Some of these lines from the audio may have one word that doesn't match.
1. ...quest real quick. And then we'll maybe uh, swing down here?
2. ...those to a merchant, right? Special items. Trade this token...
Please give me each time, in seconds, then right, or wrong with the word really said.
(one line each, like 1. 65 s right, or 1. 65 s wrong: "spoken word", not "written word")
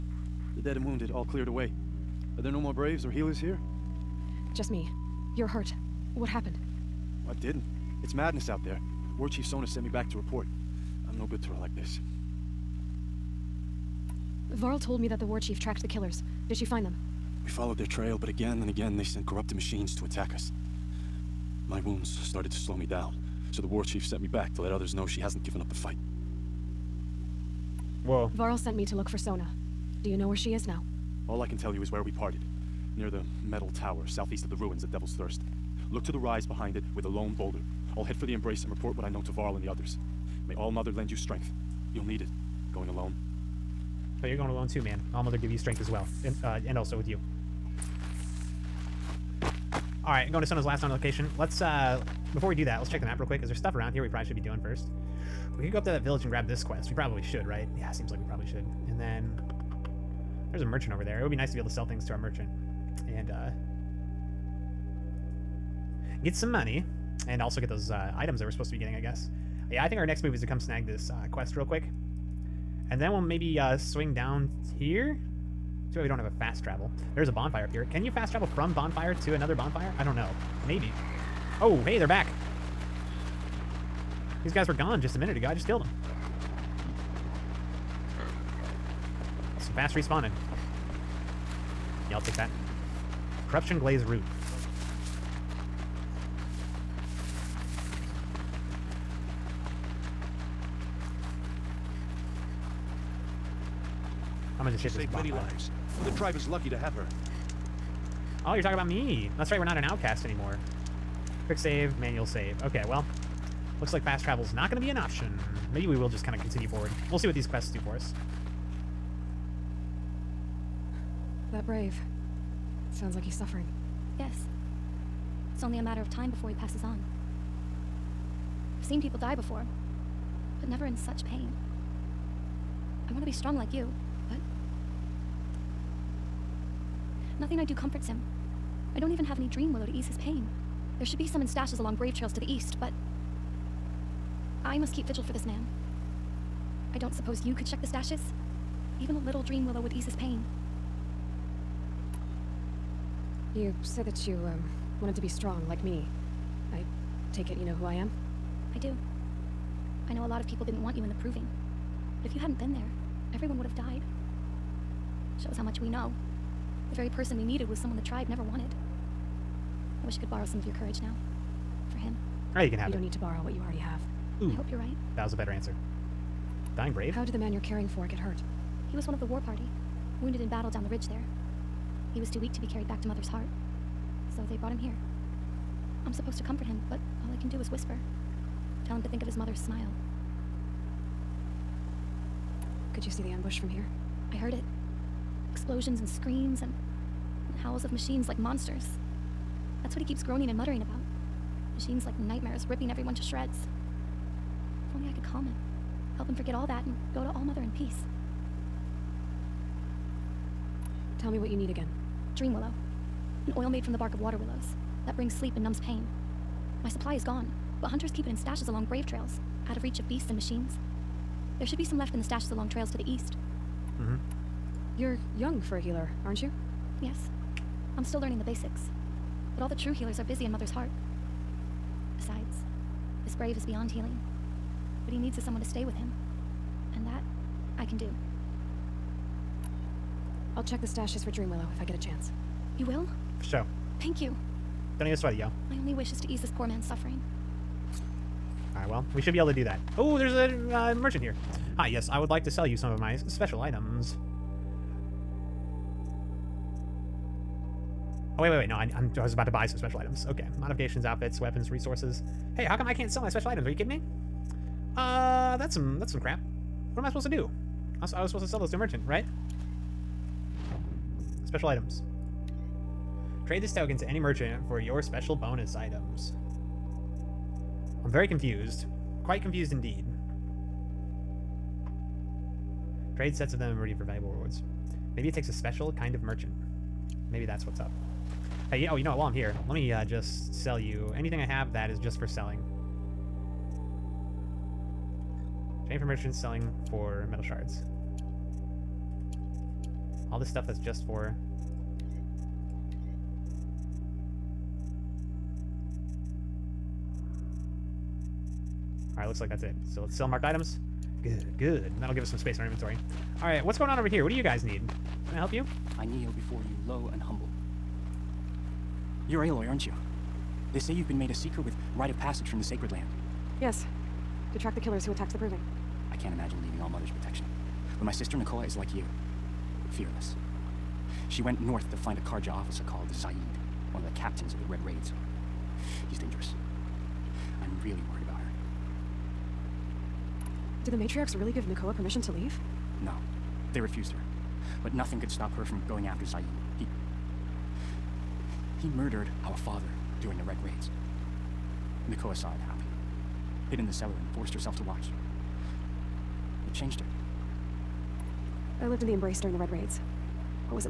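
1. 71 s right
2. 268 s right.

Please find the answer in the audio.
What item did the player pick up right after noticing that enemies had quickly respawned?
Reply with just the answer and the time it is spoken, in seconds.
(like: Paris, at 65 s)
Corruption Glaze Root, at 93 s.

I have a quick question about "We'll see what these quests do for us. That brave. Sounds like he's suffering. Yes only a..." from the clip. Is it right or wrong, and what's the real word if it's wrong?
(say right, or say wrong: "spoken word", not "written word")
right.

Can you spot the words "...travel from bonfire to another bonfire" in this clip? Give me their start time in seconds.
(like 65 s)
78 s.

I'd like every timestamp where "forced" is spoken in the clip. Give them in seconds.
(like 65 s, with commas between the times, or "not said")
354 s.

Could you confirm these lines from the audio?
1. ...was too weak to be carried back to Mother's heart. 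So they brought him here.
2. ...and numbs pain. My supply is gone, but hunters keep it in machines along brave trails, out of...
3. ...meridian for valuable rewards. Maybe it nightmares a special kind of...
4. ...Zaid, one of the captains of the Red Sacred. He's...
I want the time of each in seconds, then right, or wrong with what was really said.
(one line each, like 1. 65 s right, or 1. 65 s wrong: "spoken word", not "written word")
1. 182 s right
2. 215 s wrong: "stashes", not "machines"
3. 283 s wrong: "takes", not "nightmares"
4. 333 s wrong: "Raids", not "Sacred".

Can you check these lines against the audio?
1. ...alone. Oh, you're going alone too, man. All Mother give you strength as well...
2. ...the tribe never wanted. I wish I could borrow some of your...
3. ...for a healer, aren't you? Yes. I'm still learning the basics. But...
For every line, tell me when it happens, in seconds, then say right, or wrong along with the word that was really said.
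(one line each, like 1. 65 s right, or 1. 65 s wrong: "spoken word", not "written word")
1. 42 s right
2. 167 s right
3. 225 s right.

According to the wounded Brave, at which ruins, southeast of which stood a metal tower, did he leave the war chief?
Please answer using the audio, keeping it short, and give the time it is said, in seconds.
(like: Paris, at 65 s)
Devil's Thirst, at 34 s.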